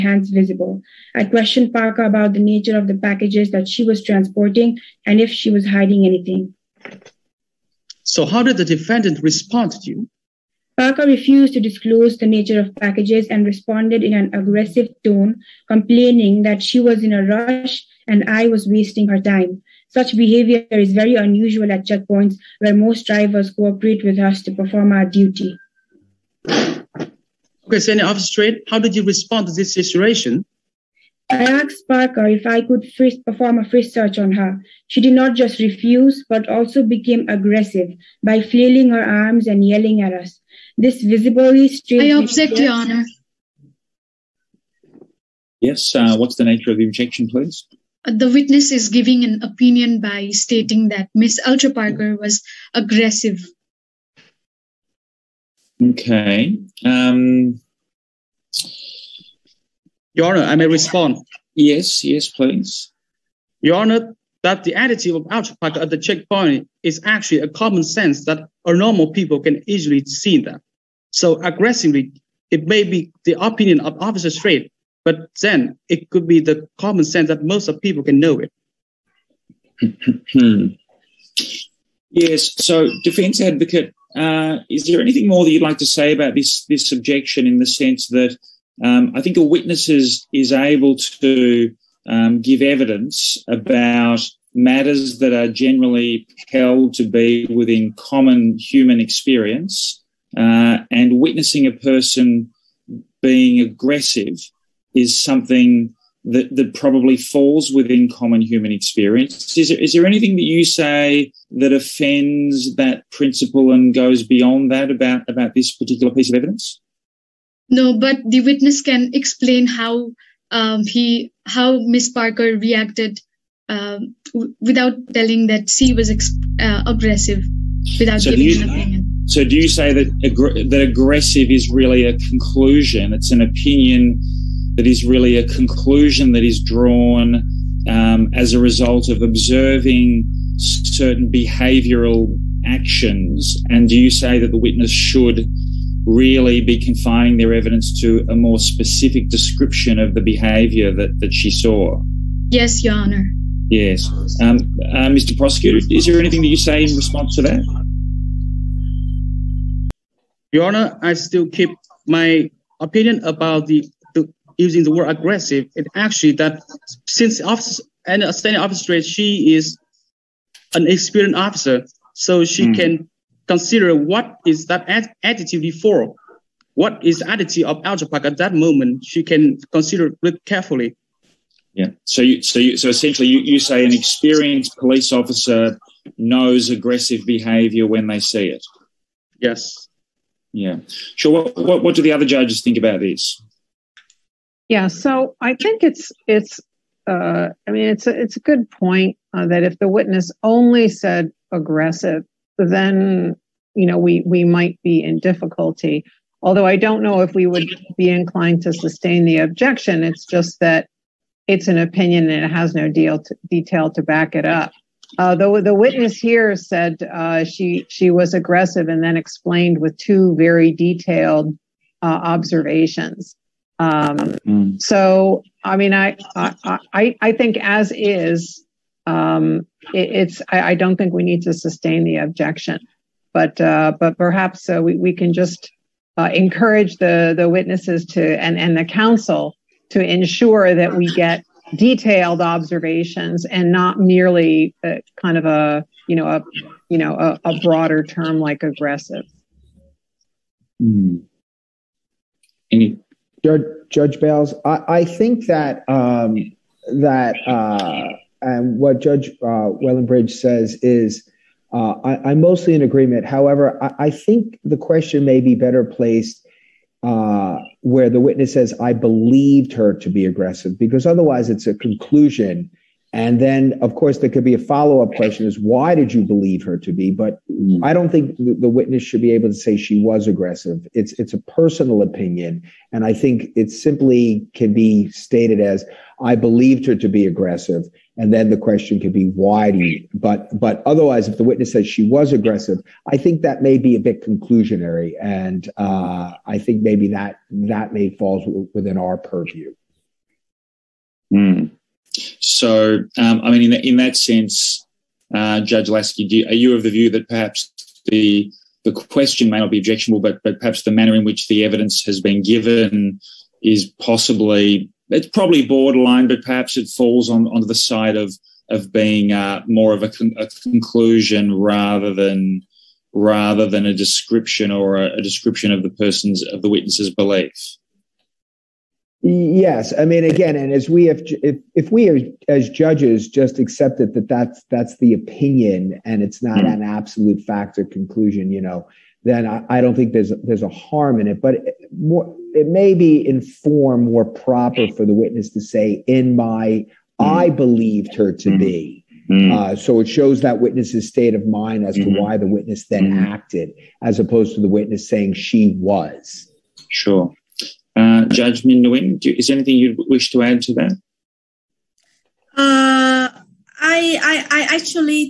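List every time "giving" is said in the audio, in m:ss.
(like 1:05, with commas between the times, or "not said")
0:48, 2:08.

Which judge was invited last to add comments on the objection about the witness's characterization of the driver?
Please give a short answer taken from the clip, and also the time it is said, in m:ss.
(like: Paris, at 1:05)
Judge Min Nguyen, at 5:58.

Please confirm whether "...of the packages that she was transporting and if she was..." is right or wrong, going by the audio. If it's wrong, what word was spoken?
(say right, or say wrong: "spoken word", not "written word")
right.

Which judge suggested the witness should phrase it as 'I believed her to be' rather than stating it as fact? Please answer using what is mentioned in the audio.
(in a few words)
Judge Lasky.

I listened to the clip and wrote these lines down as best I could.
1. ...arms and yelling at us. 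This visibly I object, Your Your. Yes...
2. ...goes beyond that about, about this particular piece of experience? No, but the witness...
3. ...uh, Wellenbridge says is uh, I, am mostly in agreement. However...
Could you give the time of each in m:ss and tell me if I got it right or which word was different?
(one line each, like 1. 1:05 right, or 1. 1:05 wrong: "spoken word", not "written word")
1. 0:39 wrong: "Honor", not "Your"
2. 1:53 wrong: "evidence", not "experience"
3. 4:19 right.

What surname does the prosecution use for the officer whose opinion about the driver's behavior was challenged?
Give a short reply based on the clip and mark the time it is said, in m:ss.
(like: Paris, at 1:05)
Strait, at 1:14.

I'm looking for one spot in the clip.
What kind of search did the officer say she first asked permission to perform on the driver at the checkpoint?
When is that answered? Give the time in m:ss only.
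0:33.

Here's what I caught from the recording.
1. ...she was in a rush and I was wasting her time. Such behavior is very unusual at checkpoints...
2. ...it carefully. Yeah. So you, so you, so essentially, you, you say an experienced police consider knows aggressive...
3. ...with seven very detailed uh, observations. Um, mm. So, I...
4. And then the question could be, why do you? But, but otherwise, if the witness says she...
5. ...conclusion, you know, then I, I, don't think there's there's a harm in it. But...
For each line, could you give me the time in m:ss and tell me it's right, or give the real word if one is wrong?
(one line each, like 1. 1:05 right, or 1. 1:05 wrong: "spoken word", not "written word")
1. 0:16 right
2. 3:00 wrong: "officer", not "consider"
3. 3:39 wrong: "two", not "seven"
4. 4:48 right
5. 5:37 right.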